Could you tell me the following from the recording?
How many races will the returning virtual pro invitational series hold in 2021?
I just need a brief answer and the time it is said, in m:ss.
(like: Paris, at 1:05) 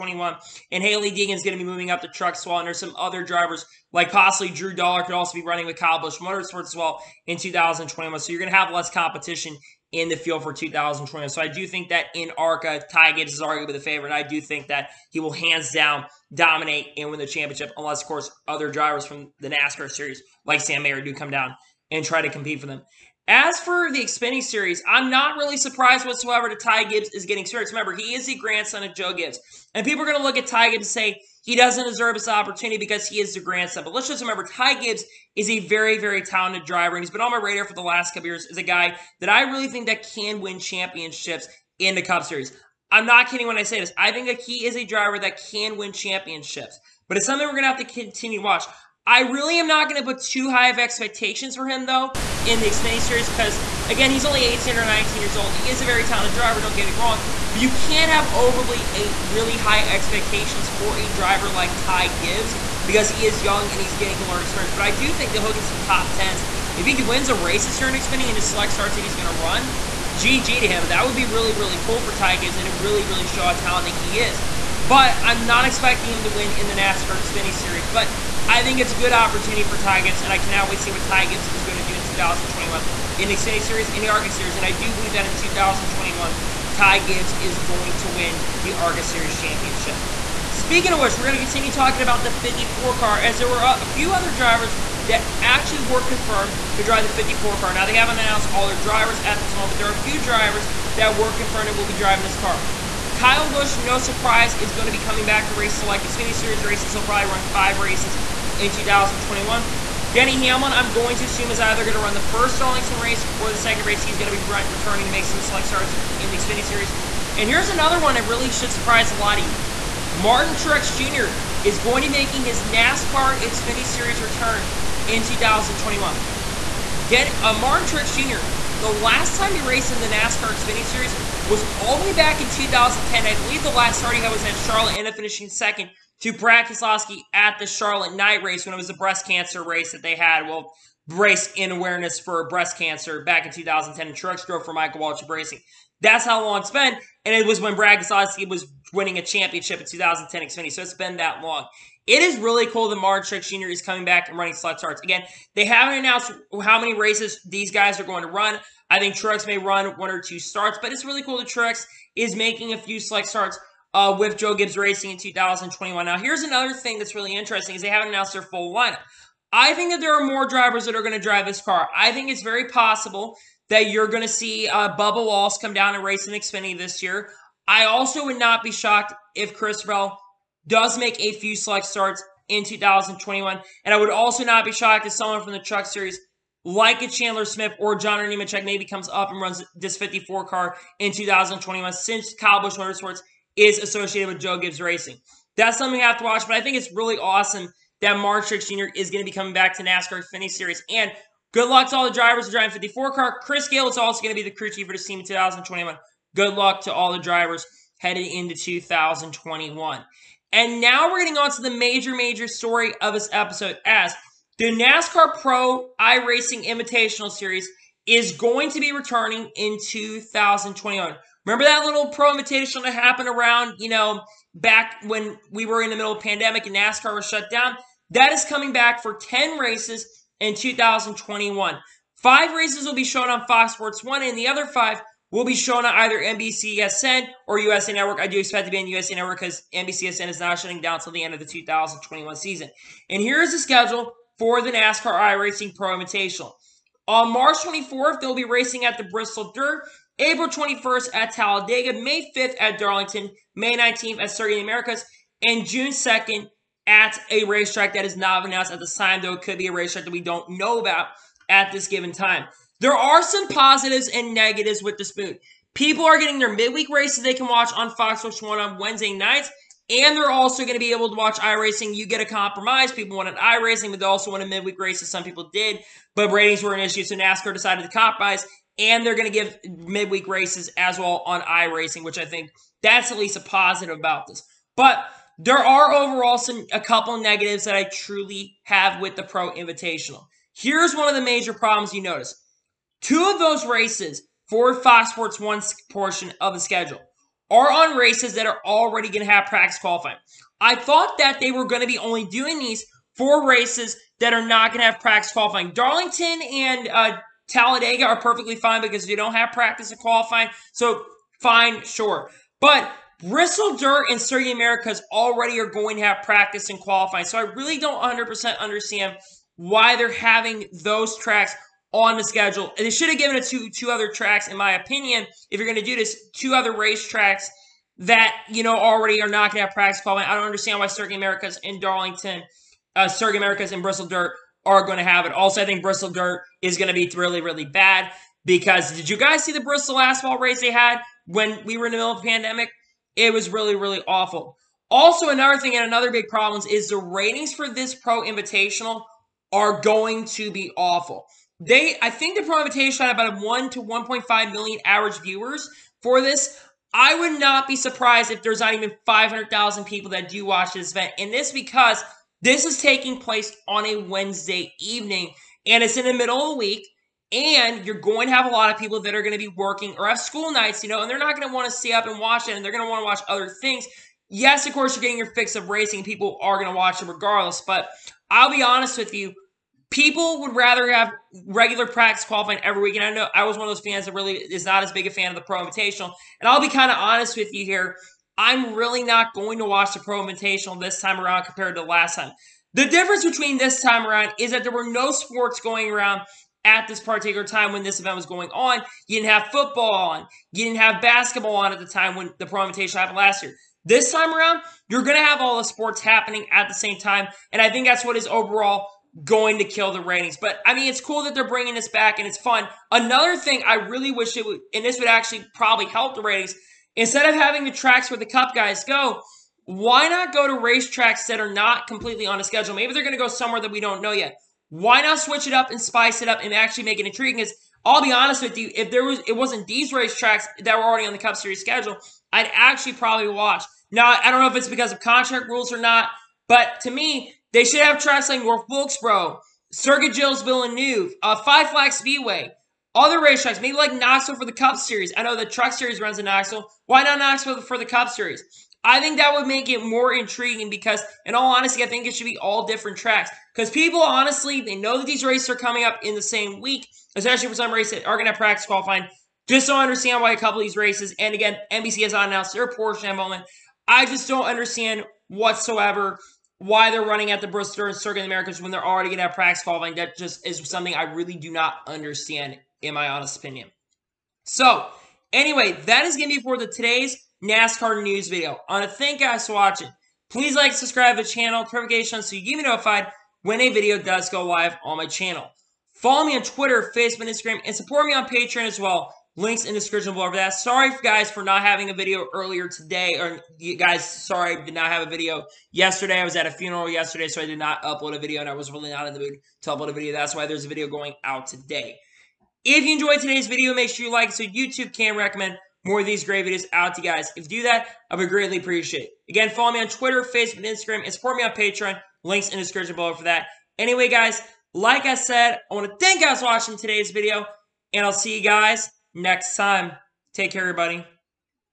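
10, at 3:49.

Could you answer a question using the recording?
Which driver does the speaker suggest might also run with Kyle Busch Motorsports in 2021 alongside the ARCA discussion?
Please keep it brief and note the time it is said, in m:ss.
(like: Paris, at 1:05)
Drew Dollar, at 0:04.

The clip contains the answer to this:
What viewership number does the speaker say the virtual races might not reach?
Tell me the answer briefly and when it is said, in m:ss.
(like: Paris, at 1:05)
500,000, at 5:59.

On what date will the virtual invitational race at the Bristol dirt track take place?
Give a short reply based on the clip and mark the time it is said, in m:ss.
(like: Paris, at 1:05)
March 24, at 4:07.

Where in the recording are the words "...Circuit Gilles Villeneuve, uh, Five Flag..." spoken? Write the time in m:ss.
7:19.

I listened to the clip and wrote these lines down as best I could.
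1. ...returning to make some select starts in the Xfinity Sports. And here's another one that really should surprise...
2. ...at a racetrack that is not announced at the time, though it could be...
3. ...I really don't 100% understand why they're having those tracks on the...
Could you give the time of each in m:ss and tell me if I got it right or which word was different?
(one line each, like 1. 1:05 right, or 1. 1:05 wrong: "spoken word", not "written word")
1. 1:54 wrong: "Series", not "Sports"
2. 4:16 right
3. 5:17 right.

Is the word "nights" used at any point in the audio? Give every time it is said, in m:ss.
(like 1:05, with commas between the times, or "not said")
2:18, 4:29, 6:10.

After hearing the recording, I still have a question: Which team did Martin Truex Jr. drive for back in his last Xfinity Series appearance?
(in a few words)
Michael Waltrip Racing.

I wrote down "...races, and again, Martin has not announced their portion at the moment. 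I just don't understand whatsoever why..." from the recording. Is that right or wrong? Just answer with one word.
wrong.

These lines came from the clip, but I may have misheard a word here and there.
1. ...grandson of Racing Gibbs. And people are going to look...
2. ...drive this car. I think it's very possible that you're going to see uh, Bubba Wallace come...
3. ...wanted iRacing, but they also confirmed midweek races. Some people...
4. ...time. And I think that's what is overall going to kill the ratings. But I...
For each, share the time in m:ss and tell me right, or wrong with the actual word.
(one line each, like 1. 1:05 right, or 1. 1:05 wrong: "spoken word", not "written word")
1. 0:28 wrong: "Joe", not "Racing"
2. 2:51 right
3. 4:33 wrong: "wanted", not "confirmed"
4. 6:46 right.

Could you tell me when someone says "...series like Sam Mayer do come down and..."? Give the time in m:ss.
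0:19.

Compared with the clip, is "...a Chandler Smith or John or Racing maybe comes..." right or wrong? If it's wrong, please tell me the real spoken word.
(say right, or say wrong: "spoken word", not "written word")
wrong: "Nemechek", not "Racing".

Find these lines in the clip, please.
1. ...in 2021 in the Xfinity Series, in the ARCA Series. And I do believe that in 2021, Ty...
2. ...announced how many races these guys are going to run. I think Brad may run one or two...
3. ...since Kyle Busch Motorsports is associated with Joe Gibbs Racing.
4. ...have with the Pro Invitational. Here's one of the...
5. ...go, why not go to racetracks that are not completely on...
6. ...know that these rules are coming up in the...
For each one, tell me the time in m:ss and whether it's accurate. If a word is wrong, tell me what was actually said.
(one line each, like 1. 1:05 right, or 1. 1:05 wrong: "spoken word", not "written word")
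1. 1:21 right
2. 2:35 wrong: "Truex", not "Brad"
3. 3:11 right
4. 4:48 right
5. 6:58 right
6. 7:34 wrong: "races", not "rules".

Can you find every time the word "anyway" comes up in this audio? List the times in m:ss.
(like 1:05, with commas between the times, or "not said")
7:55, 8:33.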